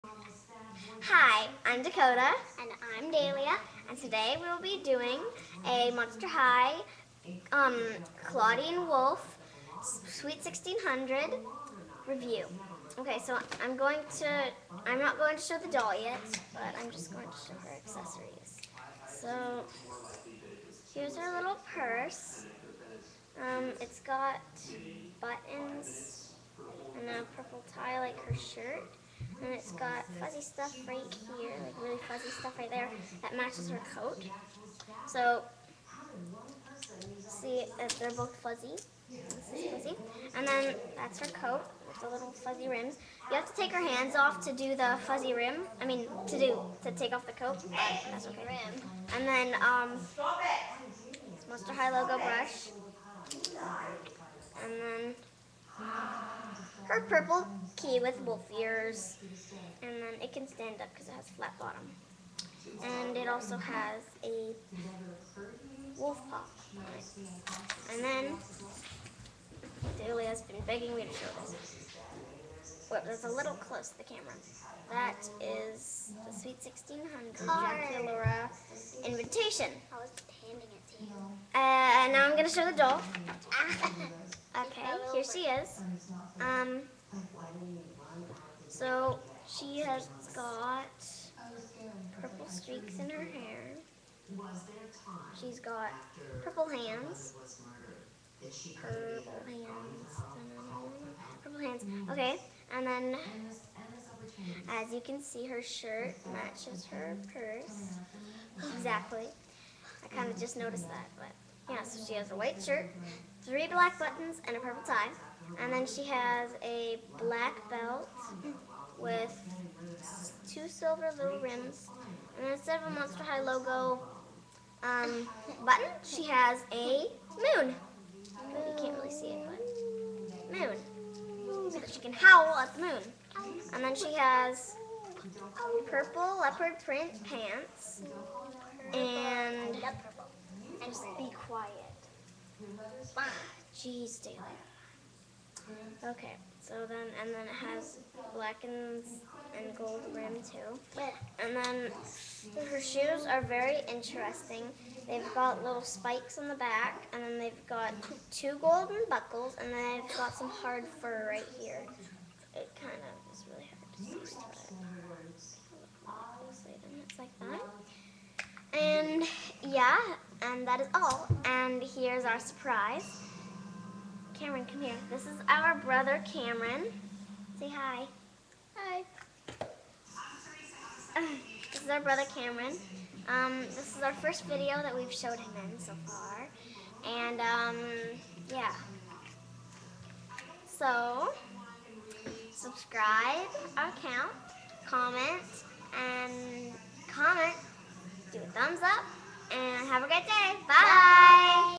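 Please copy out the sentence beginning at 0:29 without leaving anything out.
And it's got fuzzy stuff right here, like really fuzzy stuff right there that matches her coat.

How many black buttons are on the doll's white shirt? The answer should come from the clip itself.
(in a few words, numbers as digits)
3.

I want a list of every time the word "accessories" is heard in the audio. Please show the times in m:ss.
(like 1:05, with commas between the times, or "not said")
0:17.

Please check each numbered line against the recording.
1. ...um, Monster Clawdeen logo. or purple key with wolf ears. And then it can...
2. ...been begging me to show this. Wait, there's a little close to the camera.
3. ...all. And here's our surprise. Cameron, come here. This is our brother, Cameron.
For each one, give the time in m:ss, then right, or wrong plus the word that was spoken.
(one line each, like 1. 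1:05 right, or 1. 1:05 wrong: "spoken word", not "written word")
1. 0:49 wrong: "High", not "Clawdeen"
2. 1:10 right
3. 2:50 right.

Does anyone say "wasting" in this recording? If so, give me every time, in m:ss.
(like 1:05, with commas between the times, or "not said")
not said.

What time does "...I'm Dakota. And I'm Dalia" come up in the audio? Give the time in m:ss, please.
0:01.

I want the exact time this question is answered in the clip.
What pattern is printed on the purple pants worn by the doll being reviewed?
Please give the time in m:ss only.
2:15.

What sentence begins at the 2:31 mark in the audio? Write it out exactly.
And then her shoes are very interesting.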